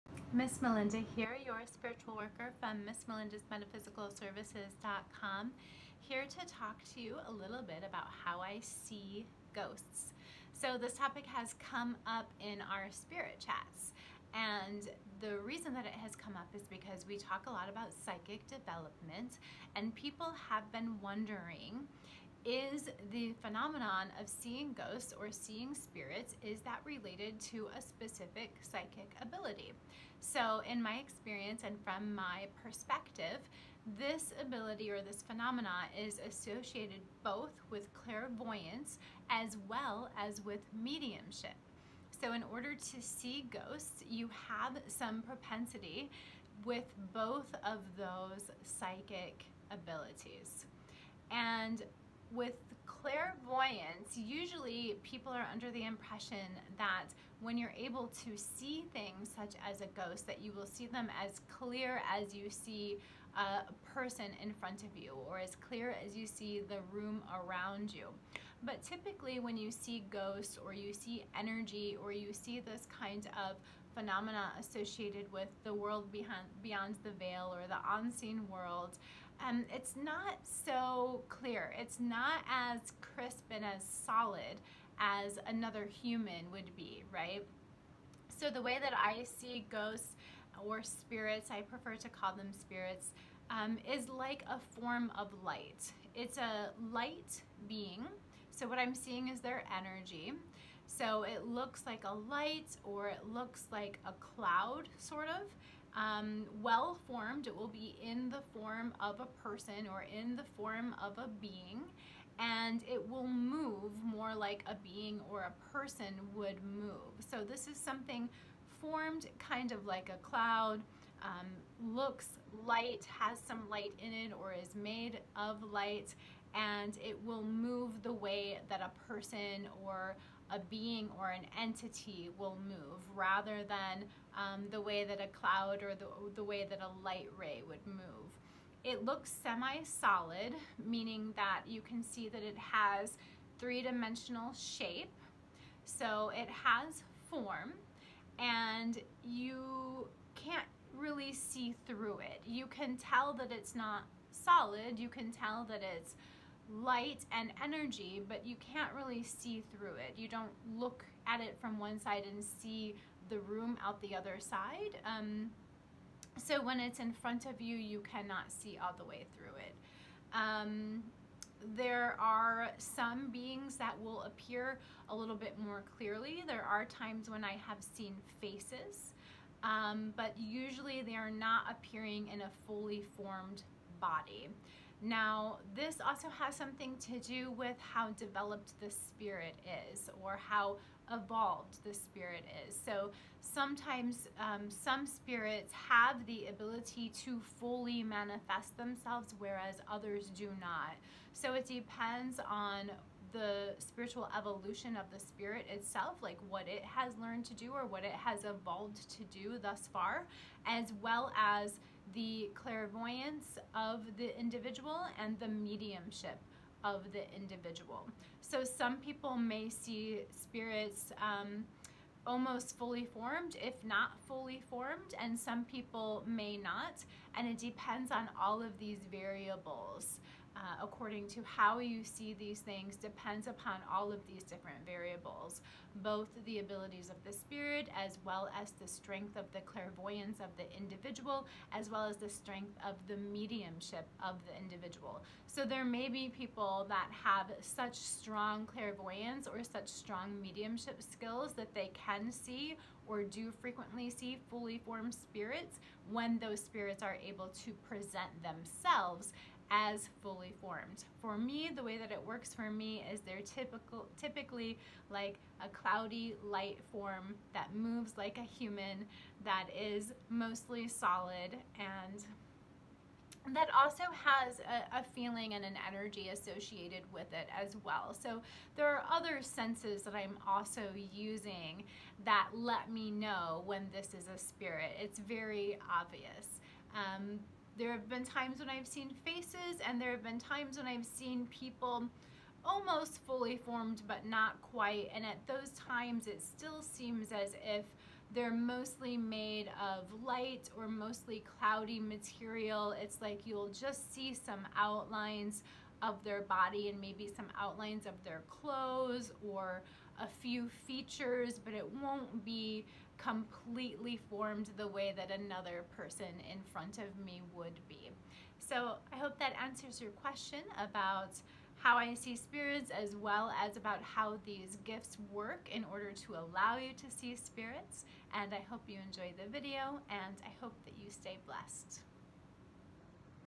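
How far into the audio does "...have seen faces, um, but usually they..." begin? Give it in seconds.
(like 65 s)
177 s.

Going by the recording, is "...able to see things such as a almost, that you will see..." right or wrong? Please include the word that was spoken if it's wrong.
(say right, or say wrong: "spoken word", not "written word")
wrong: "ghost", not "almost".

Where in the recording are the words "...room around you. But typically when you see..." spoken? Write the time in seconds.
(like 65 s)
66 s.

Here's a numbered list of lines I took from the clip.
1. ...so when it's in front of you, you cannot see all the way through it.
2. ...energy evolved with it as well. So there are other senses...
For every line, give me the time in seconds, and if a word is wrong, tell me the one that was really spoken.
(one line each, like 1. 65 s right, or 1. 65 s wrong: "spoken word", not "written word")
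1. 166 s right
2. 275 s wrong: "associated", not "evolved".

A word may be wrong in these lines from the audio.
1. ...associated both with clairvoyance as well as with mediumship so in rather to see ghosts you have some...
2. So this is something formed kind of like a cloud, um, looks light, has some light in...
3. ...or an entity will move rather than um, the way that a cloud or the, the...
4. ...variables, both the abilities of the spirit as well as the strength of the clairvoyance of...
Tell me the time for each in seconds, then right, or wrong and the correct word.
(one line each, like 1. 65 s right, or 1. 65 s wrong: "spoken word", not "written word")
1. 36 s wrong: "order", not "rather"
2. 117 s right
3. 131 s right
4. 234 s right.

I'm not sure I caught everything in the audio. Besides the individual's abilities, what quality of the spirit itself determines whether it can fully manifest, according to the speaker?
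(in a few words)
spiritual evolution.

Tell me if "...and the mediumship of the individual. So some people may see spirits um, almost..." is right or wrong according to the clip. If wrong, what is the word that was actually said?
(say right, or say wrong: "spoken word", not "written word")
right.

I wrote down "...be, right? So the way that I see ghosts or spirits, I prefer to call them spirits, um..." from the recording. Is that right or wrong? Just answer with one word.
right.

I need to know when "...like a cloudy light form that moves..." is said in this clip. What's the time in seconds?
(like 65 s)
265 s.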